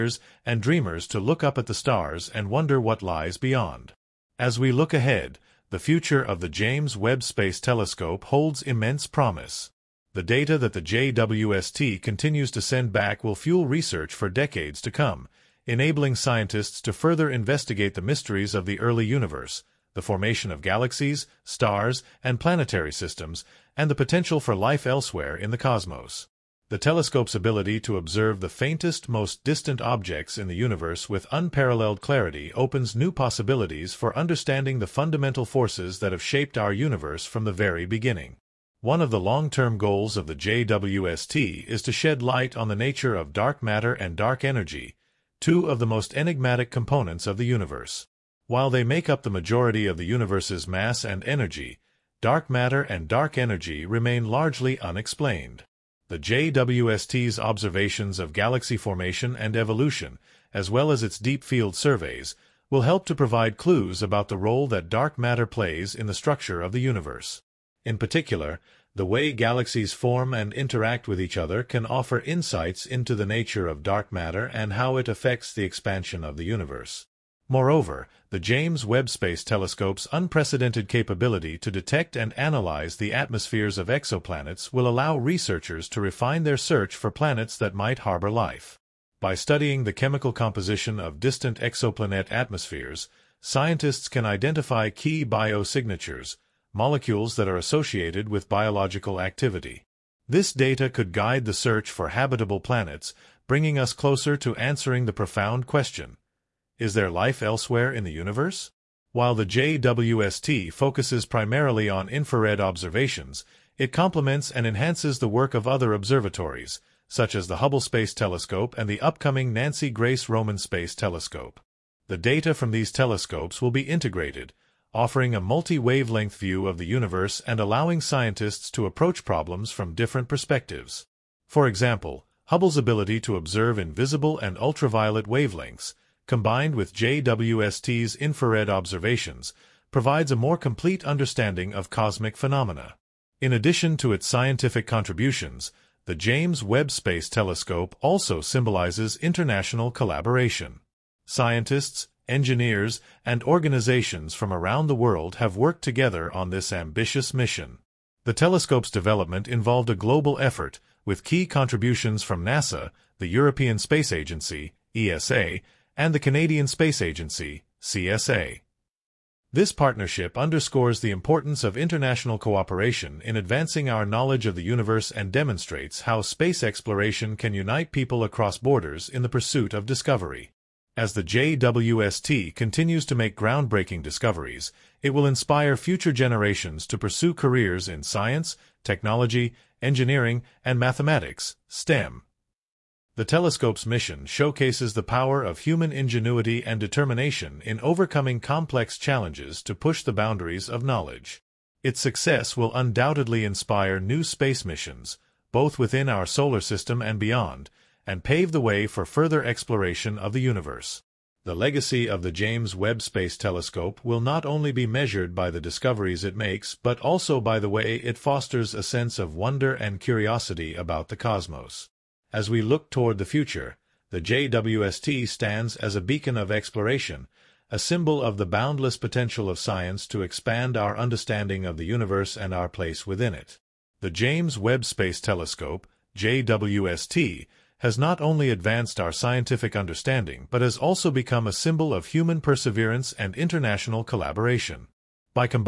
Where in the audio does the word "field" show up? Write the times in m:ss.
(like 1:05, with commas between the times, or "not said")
1:01.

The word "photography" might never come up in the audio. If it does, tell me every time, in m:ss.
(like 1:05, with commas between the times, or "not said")
not said.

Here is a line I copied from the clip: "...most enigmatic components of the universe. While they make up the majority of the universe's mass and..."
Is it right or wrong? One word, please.
right.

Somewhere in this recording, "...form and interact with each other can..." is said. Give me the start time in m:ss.
1:09.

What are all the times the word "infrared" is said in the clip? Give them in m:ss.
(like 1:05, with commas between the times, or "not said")
1:52, 2:18.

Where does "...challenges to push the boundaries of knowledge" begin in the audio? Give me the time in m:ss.
3:18.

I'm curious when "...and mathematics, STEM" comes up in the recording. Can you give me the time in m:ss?
3:10.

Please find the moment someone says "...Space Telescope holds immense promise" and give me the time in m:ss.
0:07.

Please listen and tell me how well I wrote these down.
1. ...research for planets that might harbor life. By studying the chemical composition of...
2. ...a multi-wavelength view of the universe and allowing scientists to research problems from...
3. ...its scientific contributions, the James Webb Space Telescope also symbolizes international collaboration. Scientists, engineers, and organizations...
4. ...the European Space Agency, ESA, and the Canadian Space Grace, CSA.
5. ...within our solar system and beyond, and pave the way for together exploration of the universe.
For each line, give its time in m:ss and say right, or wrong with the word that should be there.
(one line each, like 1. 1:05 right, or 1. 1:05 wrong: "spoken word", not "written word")
1. 1:26 wrong: "search", not "research"
2. 2:05 wrong: "approach", not "research"
3. 2:24 right
4. 2:43 wrong: "Agency", not "Grace"
5. 3:25 wrong: "further", not "together".